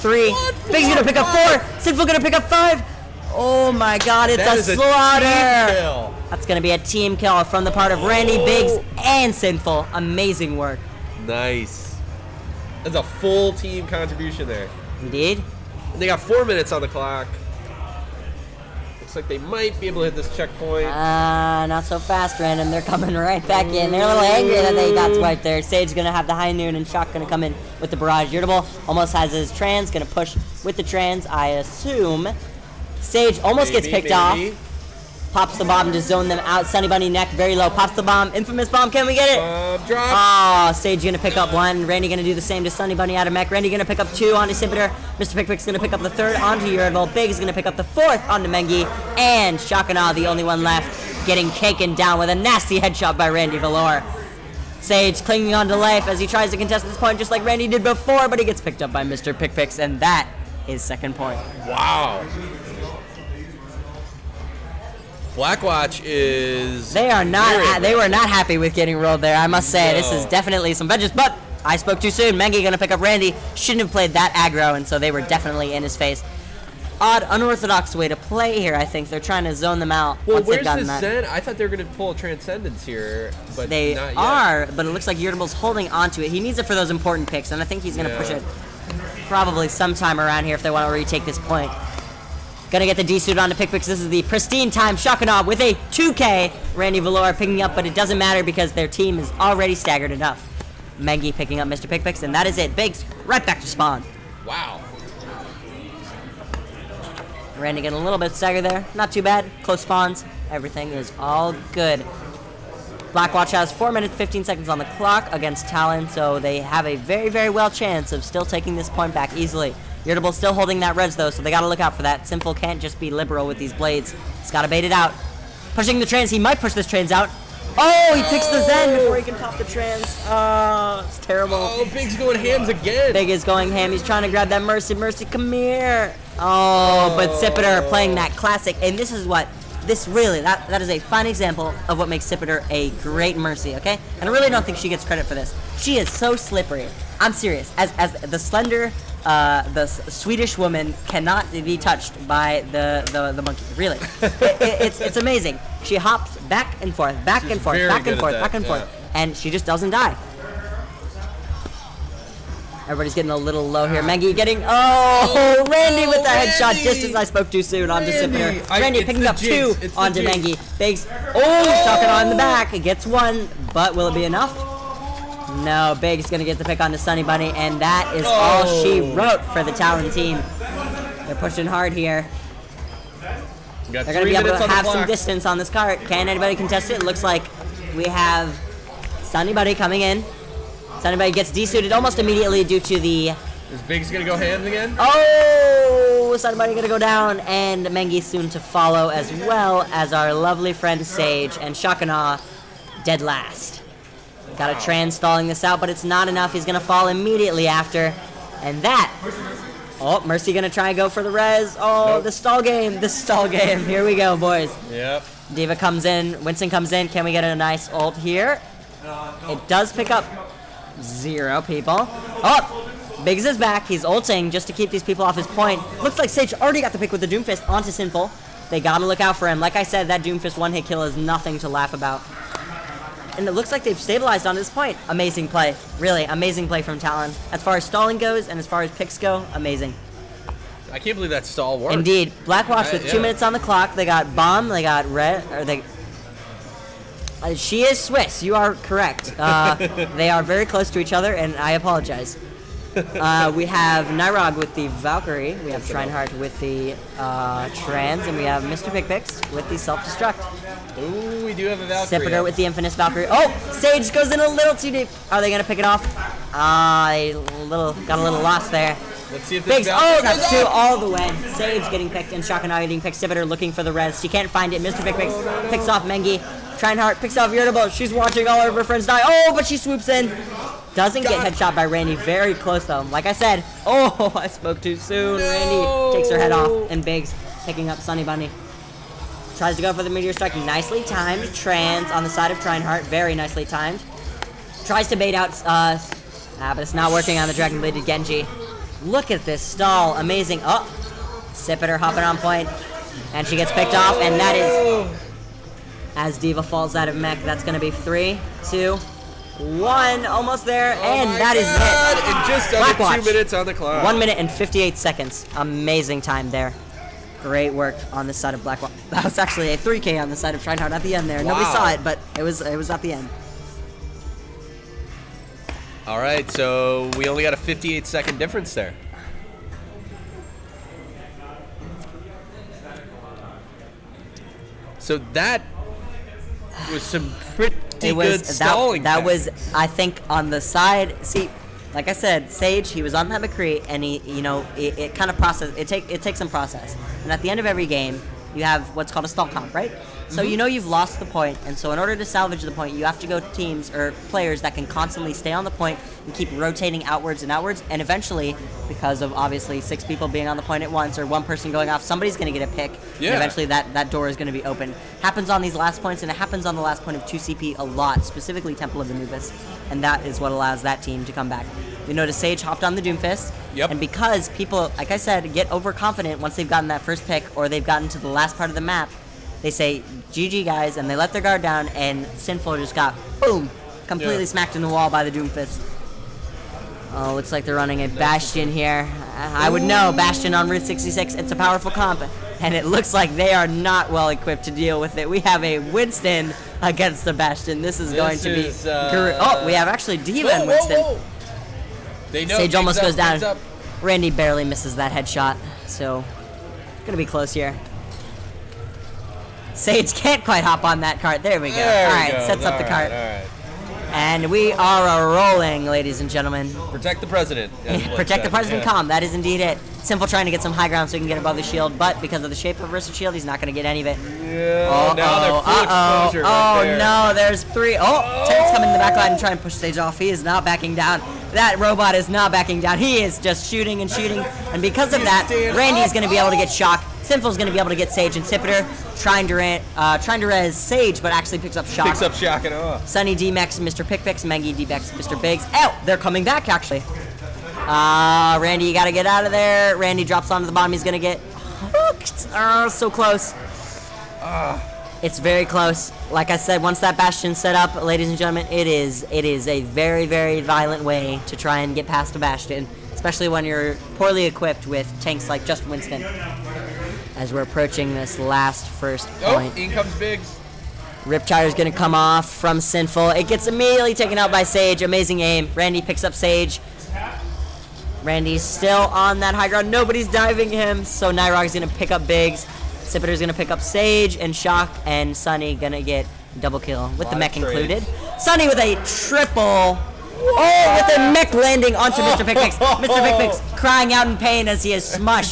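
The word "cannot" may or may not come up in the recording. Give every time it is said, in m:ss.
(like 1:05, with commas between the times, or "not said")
2:31.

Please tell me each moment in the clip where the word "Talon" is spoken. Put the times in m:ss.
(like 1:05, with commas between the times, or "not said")
1:55, 2:59, 3:56.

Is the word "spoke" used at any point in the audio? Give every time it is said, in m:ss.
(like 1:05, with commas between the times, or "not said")
1:11, 2:47, 4:44.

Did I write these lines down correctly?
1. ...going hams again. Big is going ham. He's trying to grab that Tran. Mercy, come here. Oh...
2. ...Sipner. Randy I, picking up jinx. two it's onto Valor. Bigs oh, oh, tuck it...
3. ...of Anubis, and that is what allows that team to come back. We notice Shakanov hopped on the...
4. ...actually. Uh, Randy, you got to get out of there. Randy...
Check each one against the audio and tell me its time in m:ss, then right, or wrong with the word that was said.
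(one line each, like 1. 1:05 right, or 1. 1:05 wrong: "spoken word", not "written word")
1. 2:12 wrong: "Mercy", not "Tran"
2. 2:48 wrong: "Mengi", not "Valor"
3. 6:09 wrong: "Sage", not "Shakanov"
4. 7:26 right.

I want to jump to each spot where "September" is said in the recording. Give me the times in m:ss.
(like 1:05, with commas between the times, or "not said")
not said.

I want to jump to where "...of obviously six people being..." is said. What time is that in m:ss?
5:59.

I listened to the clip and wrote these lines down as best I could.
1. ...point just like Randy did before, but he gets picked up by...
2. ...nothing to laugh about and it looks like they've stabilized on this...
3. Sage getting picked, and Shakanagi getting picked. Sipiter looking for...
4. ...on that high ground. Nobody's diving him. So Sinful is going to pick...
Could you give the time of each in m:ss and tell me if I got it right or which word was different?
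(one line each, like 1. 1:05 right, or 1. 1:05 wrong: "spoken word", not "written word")
1. 0:56 right
2. 3:51 right
3. 4:31 right
4. 7:59 wrong: "Nyrog", not "Sinful".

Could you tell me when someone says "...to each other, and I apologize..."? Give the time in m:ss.
4:10.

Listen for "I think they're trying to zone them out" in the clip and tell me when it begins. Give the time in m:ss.
1:18.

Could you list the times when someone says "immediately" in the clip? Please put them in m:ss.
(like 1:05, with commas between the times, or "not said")
3:12, 3:27, 7:53.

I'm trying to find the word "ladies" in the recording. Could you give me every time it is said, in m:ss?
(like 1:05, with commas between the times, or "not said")
6:55, 7:38.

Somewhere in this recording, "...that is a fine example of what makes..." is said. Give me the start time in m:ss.
2:20.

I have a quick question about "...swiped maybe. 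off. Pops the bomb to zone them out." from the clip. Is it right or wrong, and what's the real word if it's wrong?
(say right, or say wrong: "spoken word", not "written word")
wrong: "picked", not "swiped".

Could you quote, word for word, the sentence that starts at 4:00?
I can't believe that stall worked.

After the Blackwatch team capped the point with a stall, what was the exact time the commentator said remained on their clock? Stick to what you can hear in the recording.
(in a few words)
1 minute 58 seconds.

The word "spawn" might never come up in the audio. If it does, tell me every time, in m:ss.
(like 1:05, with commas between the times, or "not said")
1:43, 1:49.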